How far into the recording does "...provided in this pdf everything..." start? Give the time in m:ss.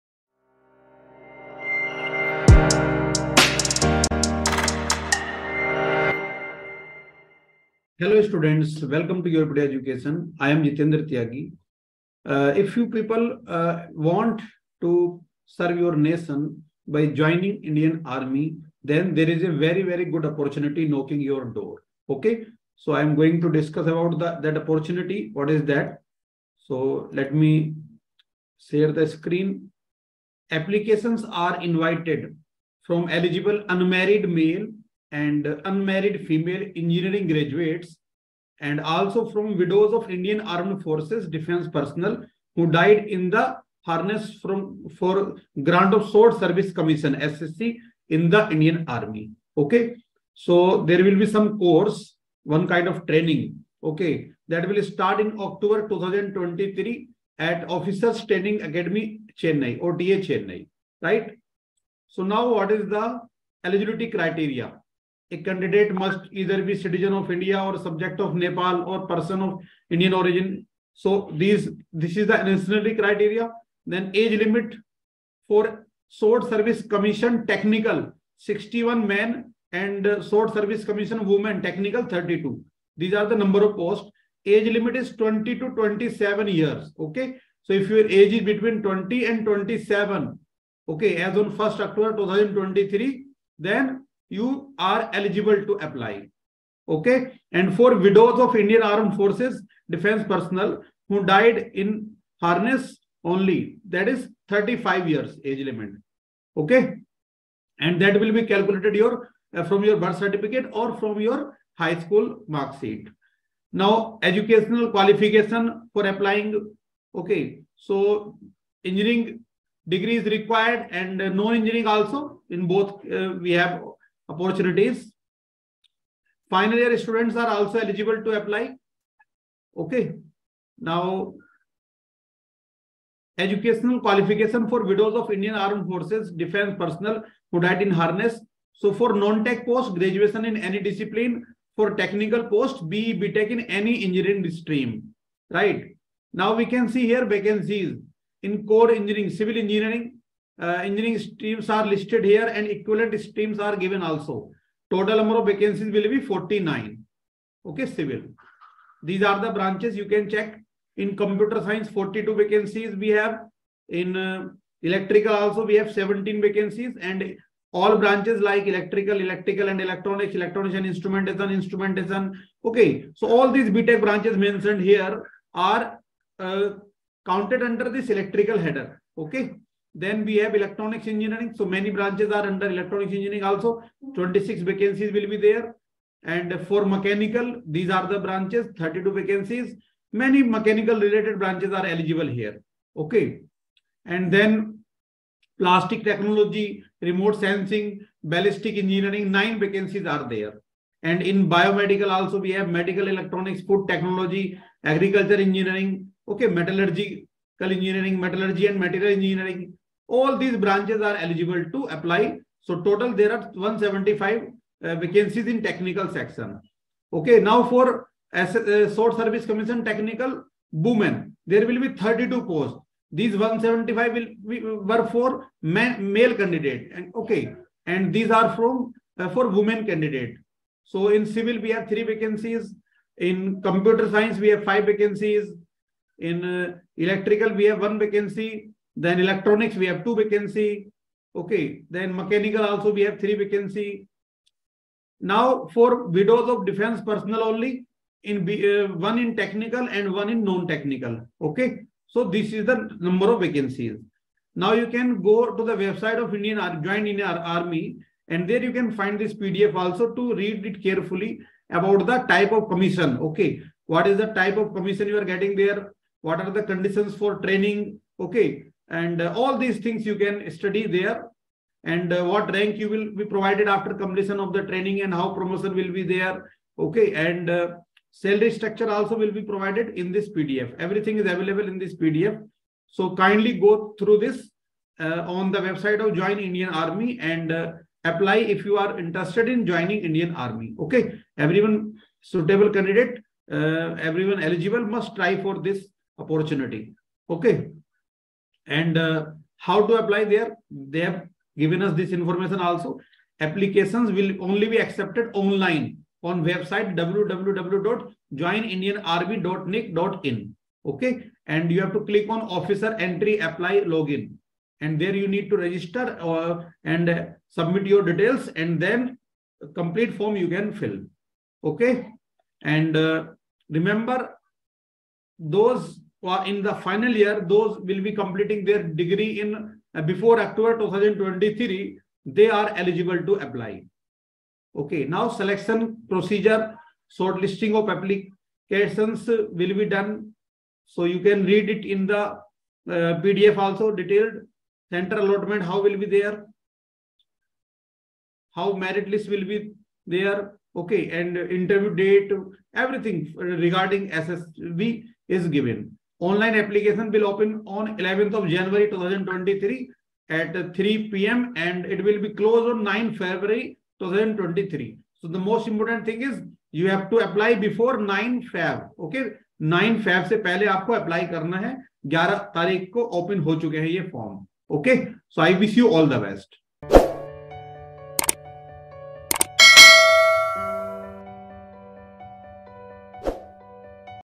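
4:39.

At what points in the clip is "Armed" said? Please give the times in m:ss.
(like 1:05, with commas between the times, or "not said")
0:40, 1:38, 2:15.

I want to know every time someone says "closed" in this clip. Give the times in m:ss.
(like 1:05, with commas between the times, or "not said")
6:02.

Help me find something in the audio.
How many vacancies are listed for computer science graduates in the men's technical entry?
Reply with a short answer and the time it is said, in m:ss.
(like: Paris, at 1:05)
42, at 2:41.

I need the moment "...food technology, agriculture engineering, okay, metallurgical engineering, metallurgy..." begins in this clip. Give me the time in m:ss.
3:23.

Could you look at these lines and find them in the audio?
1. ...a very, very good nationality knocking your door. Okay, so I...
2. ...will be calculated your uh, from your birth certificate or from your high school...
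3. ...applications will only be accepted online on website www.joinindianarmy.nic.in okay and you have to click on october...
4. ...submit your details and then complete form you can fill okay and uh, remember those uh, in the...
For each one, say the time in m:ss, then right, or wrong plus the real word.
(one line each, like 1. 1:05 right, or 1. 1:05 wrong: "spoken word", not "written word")
1. 0:19 wrong: "opportunity", not "nationality"
2. 1:48 right
3. 5:03 wrong: "officer", not "october"
4. 5:17 right.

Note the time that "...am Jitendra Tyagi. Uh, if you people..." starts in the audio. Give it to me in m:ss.
0:10.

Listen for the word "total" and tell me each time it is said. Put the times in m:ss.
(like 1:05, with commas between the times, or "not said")
2:34, 3:32.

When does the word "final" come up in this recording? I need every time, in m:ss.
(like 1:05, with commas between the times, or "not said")
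2:06, 5:26.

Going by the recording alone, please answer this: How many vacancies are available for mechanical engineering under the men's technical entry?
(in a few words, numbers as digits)
32.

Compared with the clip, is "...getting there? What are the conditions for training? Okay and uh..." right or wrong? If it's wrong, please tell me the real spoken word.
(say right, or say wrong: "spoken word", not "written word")
right.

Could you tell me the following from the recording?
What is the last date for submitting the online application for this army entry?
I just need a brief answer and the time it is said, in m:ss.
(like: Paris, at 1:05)
9 February 2023, at 6:02.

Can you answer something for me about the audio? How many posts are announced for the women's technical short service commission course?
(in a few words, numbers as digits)
32.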